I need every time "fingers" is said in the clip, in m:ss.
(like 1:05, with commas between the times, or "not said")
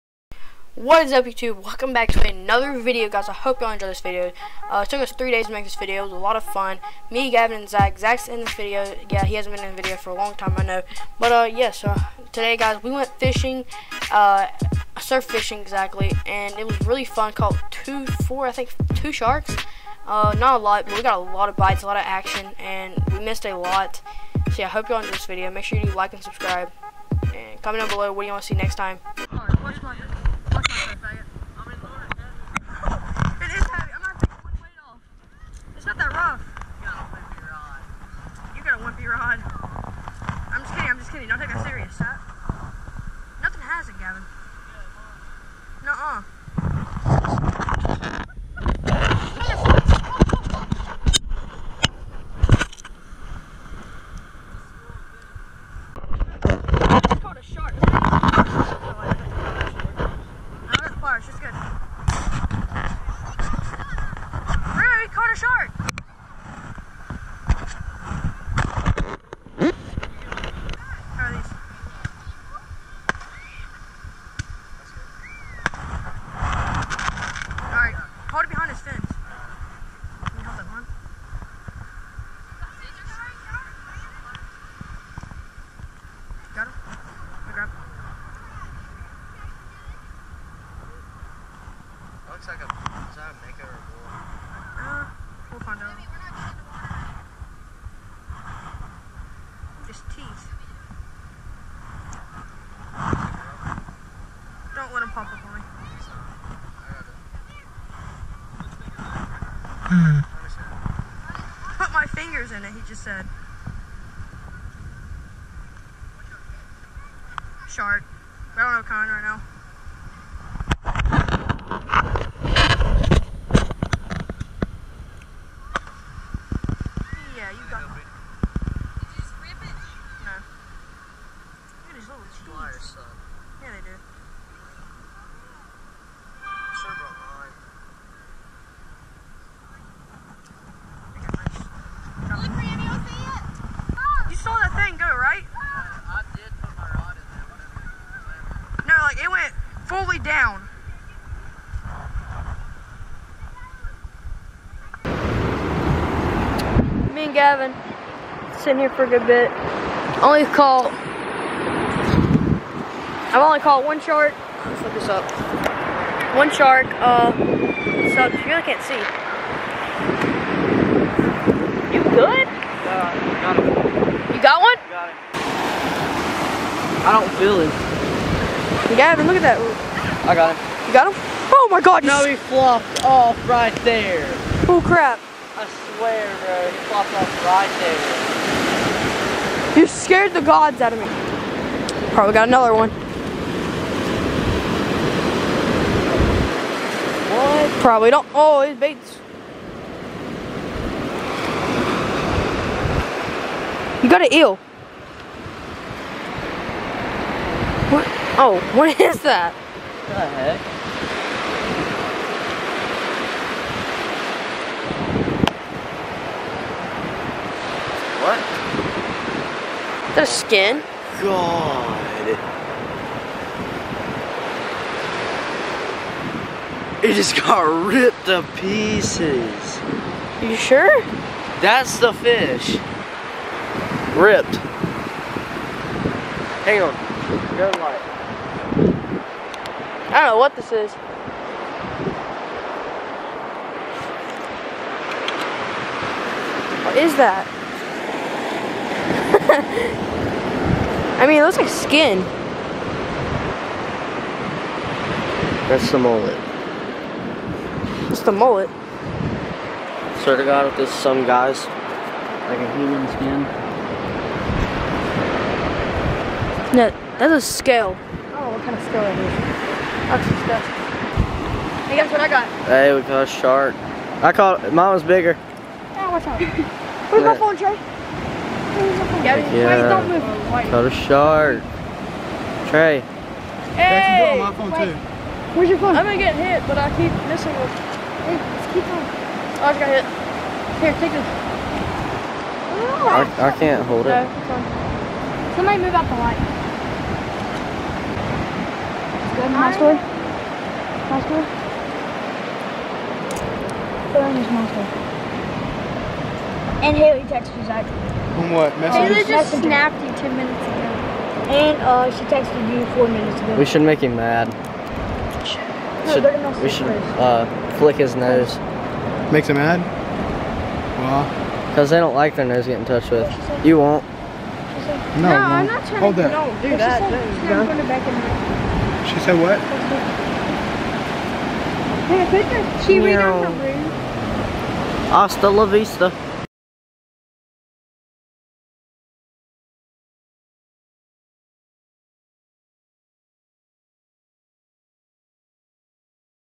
1:52.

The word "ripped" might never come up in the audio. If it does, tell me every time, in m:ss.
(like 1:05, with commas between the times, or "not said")
3:47, 3:54.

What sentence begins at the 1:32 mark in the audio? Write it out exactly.
looks like a, is that a mega or a bull?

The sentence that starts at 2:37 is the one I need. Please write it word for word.
Me and Gavin sitting here for a good bit.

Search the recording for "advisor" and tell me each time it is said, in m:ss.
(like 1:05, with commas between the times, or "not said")
not said.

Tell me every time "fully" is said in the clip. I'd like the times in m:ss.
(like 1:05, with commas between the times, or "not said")
2:29.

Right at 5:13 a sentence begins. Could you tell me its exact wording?
We should make him mad should, we should uh, flick his nose.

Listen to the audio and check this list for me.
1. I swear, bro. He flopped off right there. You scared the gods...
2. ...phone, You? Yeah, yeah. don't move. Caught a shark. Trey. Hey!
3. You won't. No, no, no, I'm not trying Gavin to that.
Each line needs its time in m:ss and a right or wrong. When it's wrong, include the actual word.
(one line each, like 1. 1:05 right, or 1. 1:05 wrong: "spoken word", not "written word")
1. 3:05 right
2. 4:37 wrong: "Trey", not "You"
3. 5:23 wrong: "Hold", not "Gavin".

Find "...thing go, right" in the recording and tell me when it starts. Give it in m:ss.
2:24.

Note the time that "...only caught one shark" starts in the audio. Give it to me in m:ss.
2:43.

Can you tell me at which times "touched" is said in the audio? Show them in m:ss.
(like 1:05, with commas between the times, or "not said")
5:22.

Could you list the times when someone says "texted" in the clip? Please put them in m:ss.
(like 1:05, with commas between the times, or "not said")
5:07, 5:12.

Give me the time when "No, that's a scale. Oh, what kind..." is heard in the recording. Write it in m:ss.
4:26.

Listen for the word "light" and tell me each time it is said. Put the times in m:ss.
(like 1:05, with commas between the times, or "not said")
3:57, 4:56.